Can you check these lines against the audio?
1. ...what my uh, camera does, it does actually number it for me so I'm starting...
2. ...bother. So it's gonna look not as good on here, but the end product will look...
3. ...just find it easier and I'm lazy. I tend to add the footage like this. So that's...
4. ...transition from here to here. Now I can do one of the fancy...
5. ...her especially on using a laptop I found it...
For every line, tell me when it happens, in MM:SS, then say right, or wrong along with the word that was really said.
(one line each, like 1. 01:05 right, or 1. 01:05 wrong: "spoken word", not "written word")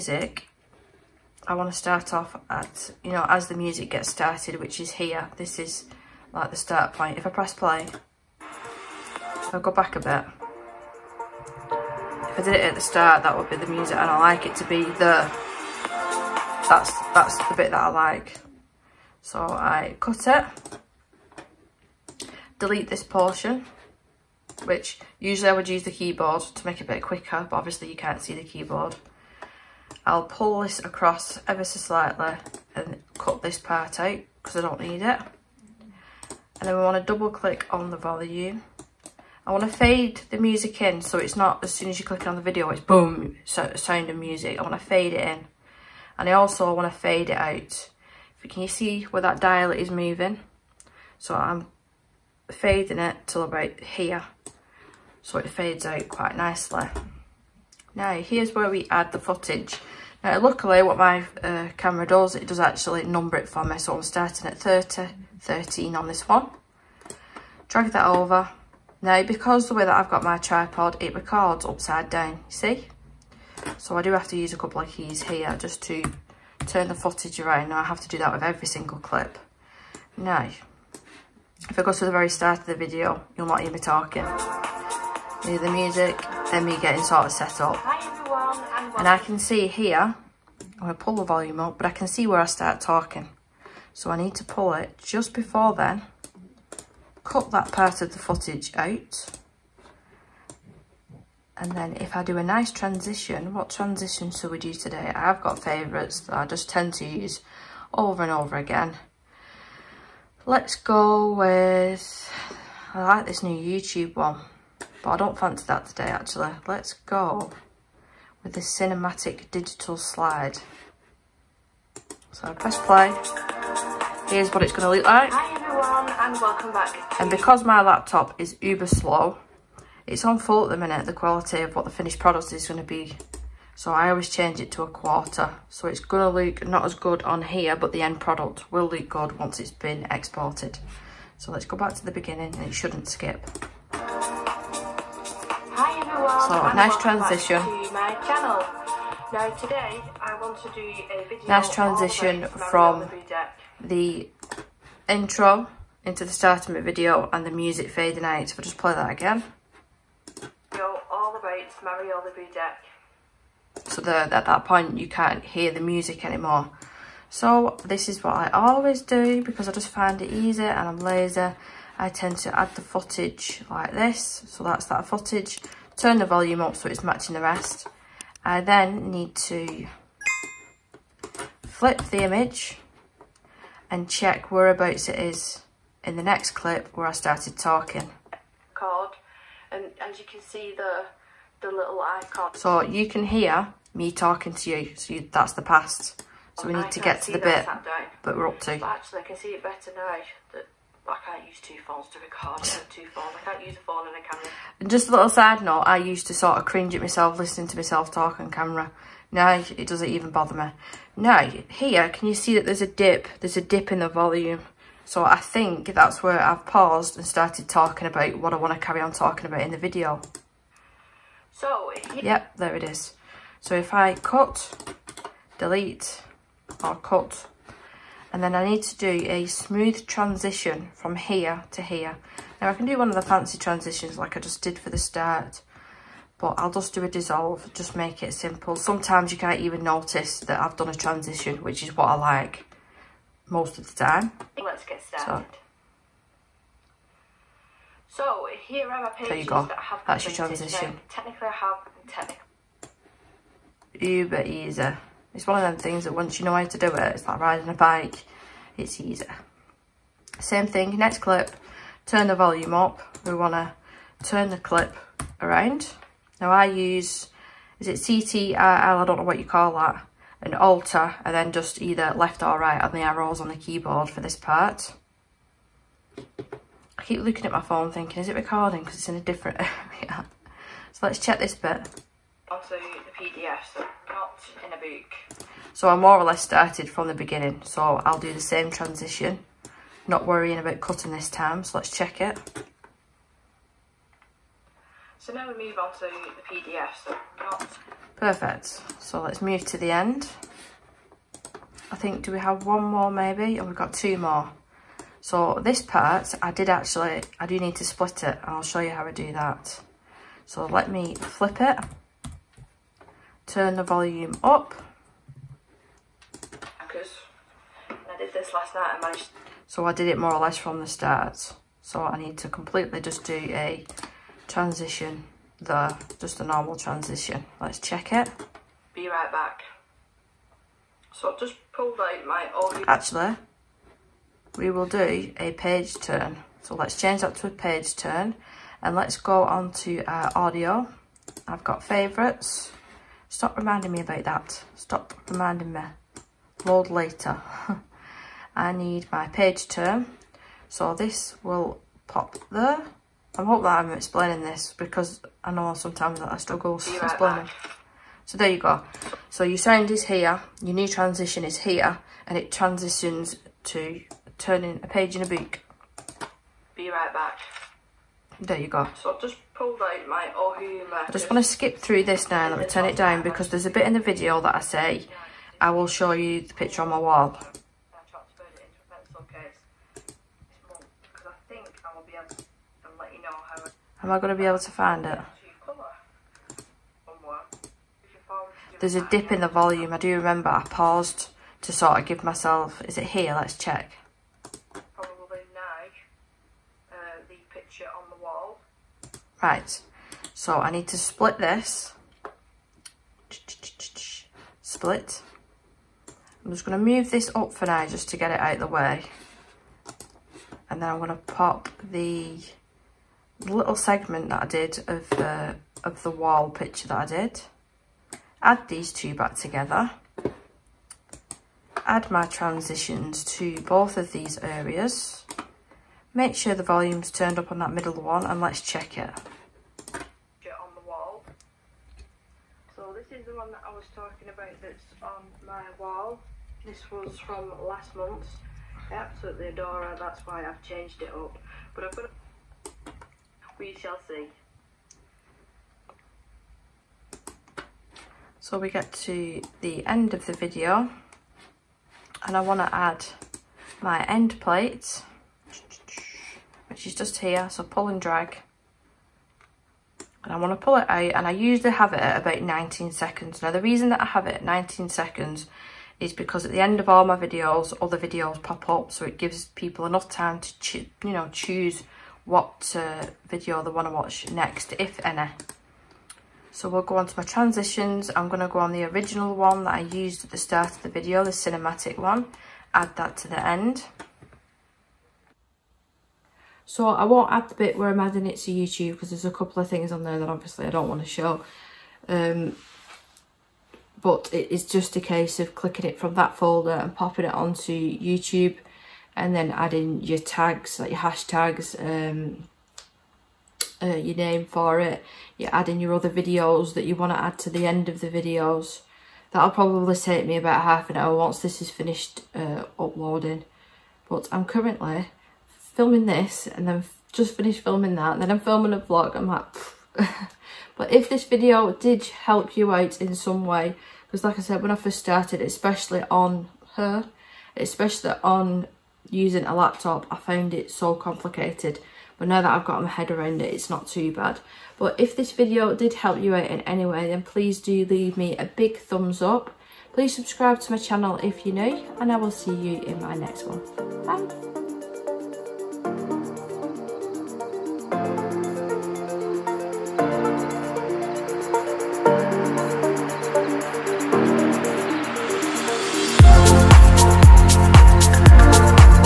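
1. 01:00 right
2. 02:14 wrong: "quarter", not "bother"
3. 02:49 right
4. 03:50 right
5. 08:46 right.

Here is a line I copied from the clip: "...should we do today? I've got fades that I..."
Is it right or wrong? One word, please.
wrong.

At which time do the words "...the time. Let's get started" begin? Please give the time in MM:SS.
04:03.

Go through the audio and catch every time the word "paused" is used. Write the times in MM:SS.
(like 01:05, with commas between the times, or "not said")
03:36, 06:30.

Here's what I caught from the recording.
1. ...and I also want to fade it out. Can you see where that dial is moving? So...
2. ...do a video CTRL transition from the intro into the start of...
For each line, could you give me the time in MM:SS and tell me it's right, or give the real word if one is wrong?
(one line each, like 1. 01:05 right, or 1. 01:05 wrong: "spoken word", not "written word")
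1. 00:46 right
2. 02:30 wrong: "Nice", not "CTRL".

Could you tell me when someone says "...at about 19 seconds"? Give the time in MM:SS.
07:41.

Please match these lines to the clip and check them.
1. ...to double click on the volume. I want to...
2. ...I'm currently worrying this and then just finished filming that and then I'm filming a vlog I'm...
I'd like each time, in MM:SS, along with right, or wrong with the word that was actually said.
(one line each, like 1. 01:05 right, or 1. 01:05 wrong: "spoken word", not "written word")
1. 00:37 right
2. 08:34 wrong: "filming", not "worrying".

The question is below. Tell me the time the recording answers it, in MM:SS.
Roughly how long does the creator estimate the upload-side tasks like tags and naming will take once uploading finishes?
08:30.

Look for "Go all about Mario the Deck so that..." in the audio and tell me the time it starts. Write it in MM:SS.
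02:40.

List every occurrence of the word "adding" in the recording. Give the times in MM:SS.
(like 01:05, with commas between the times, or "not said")
08:07, 08:19, 08:25.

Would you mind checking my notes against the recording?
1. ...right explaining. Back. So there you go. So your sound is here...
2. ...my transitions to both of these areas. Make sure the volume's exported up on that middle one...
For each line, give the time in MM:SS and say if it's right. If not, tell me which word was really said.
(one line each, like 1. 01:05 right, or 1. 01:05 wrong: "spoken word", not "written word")
1. 05:56 right
2. 07:02 wrong: "turned", not "exported".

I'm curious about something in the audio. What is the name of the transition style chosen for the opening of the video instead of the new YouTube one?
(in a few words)
cinematic digital slide.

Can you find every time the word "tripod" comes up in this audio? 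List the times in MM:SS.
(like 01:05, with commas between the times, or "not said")
01:10.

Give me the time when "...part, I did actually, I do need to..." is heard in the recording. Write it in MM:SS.
05:05.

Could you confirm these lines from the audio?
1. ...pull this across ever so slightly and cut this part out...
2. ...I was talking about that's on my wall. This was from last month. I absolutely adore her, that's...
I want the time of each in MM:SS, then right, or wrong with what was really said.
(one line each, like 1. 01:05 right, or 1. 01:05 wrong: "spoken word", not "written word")
1. 00:30 right
2. 07:13 right.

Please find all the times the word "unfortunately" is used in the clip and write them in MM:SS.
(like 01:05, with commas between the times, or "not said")
not said.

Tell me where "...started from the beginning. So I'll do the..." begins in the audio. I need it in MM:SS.
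04:46.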